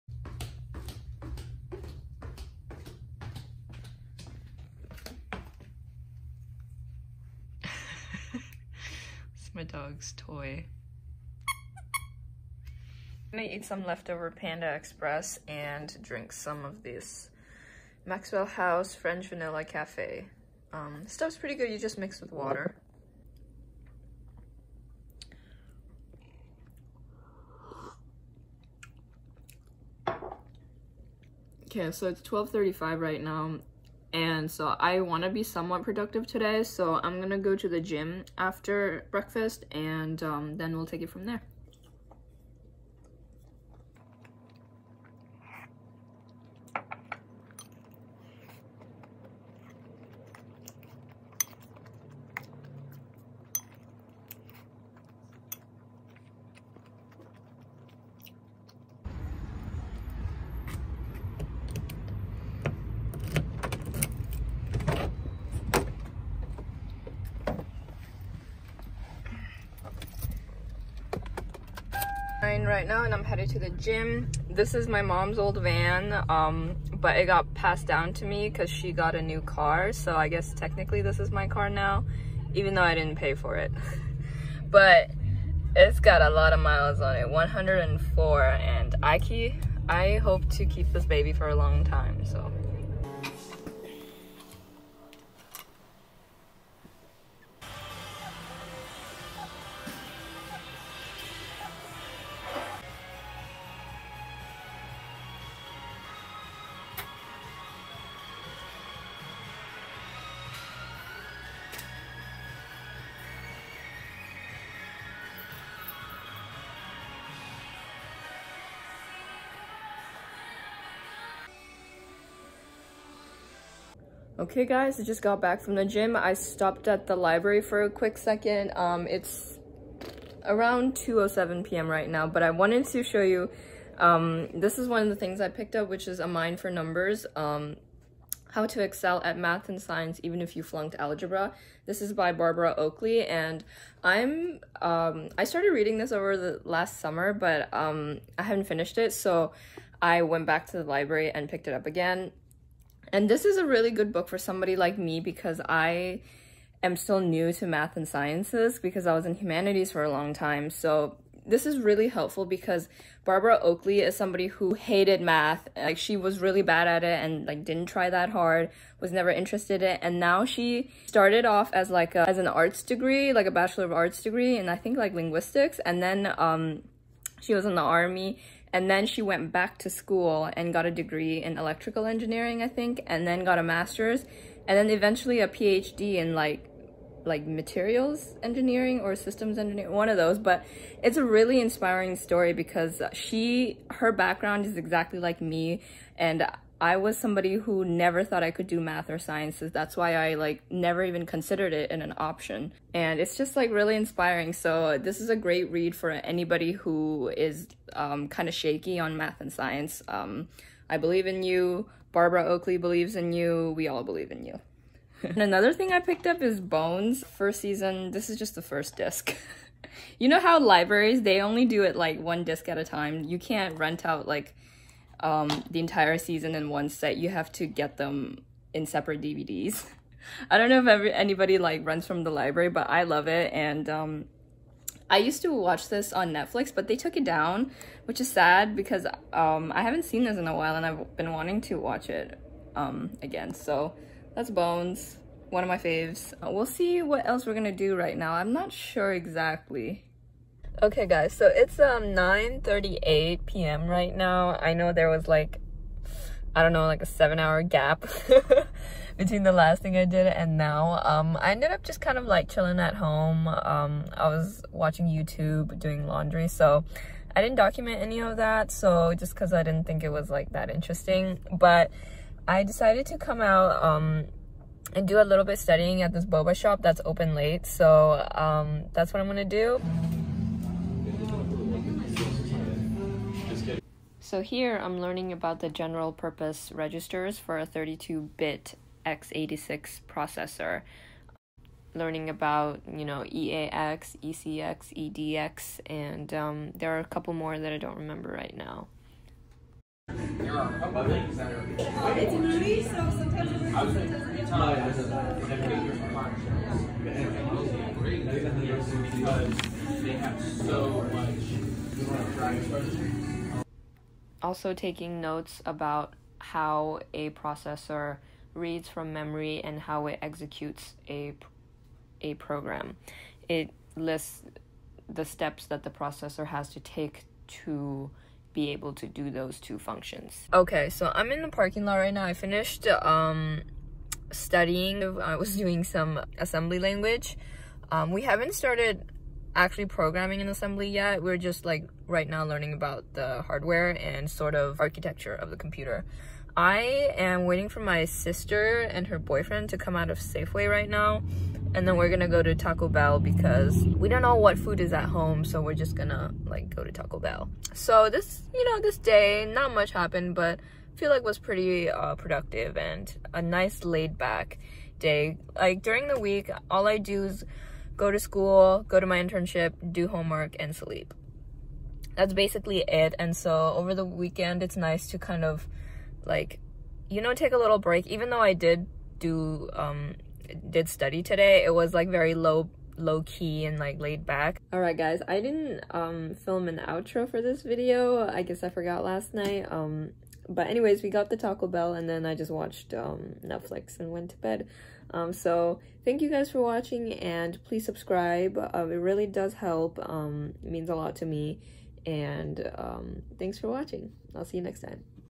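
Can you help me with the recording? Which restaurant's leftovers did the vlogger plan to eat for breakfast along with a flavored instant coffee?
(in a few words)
Panda Express.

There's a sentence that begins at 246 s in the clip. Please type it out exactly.
We'll see what else we're gonna do right now.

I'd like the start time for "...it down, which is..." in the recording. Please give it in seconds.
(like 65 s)
237 s.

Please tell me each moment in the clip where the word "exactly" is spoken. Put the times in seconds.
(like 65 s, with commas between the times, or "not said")
194 s, 249 s.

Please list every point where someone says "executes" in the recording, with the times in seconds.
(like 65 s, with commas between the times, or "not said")
320 s.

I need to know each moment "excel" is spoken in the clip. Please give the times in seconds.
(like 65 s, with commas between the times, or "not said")
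138 s.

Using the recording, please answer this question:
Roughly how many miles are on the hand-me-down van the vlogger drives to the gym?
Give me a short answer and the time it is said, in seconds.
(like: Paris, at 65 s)
104, at 87 s.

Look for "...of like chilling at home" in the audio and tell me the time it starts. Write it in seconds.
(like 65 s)
262 s.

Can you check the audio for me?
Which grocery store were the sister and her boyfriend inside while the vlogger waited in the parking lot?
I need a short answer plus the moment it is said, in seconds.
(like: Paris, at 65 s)
Safeway, at 350 s.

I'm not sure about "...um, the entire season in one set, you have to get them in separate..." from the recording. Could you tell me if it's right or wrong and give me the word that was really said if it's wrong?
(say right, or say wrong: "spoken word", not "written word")
right.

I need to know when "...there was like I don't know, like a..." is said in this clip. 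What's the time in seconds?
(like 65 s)
254 s.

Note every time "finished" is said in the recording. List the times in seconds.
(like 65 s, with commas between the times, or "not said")
148 s, 332 s.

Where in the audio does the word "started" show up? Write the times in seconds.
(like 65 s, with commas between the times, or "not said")
145 s, 171 s, 338 s.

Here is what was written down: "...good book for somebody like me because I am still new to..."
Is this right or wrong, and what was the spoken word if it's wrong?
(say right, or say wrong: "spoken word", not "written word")
right.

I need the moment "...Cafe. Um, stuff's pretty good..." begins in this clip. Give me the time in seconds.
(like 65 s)
19 s.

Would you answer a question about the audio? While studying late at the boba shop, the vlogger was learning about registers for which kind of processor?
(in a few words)
32-bit x86.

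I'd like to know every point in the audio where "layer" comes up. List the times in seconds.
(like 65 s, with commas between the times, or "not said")
not said.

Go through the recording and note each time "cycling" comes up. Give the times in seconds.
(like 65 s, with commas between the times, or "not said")
not said.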